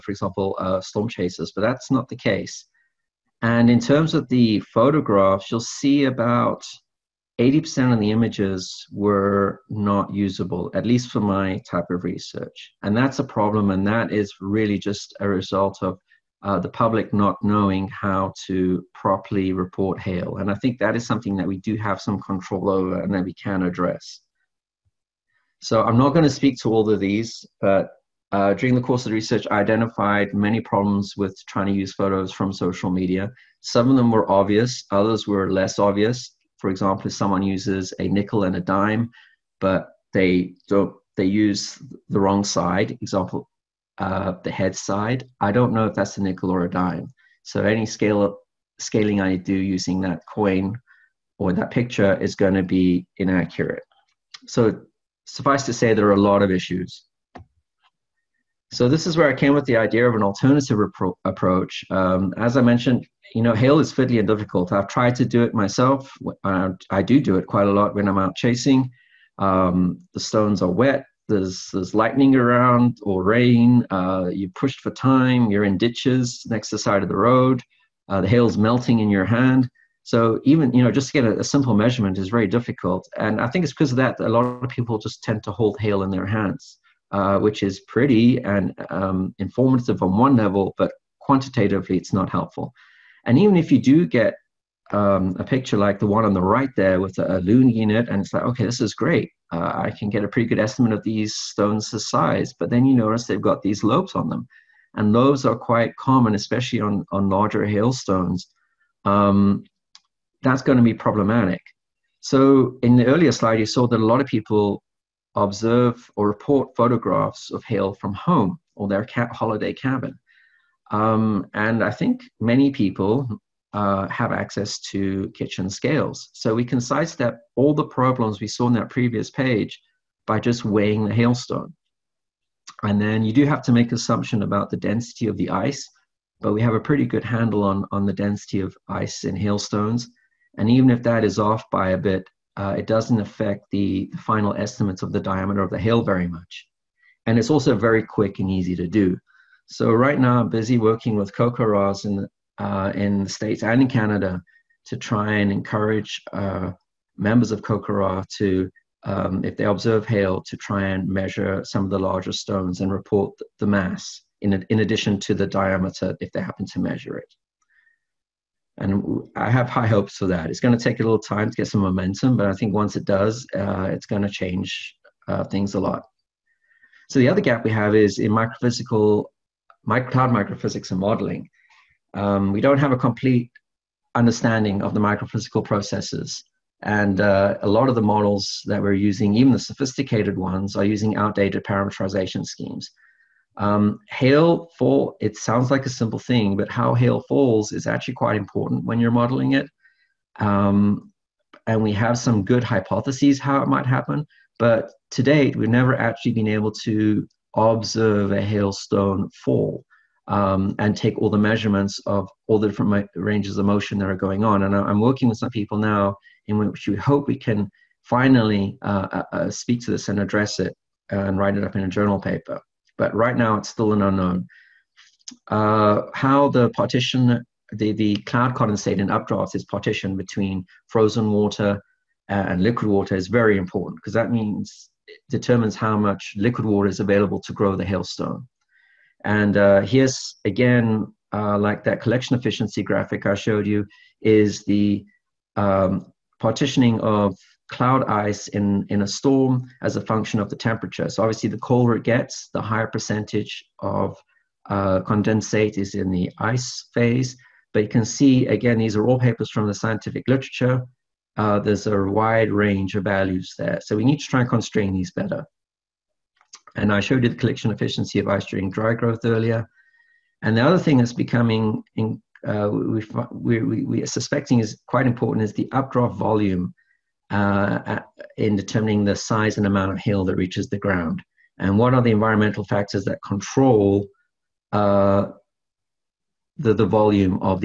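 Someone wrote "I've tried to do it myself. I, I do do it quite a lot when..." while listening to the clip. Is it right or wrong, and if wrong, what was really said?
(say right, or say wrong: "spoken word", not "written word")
right.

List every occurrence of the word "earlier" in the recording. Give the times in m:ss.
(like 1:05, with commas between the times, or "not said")
1:53, 4:29.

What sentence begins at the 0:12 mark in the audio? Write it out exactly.
And that's a problem, and that is really just a result of uh, the public not knowing how to properly report hail.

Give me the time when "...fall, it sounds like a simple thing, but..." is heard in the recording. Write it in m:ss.
3:14.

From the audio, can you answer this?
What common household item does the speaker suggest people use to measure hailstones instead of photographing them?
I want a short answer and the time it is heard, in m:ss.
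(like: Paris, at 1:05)
Kitchen scales, at 2:05.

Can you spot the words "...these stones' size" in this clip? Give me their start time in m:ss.
1:41.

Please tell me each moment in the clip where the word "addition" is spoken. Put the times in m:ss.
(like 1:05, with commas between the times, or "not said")
2:44.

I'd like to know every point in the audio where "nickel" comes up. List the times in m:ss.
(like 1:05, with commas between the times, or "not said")
0:38, 0:46.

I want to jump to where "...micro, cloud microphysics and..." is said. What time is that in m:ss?
2:59.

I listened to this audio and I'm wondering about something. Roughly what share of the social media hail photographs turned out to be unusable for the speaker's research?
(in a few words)
80%.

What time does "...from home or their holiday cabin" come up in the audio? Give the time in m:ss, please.
1:57.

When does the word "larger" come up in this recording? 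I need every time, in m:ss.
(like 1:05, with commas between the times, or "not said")
1:47, 2:41.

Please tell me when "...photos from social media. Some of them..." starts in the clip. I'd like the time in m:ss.
0:31.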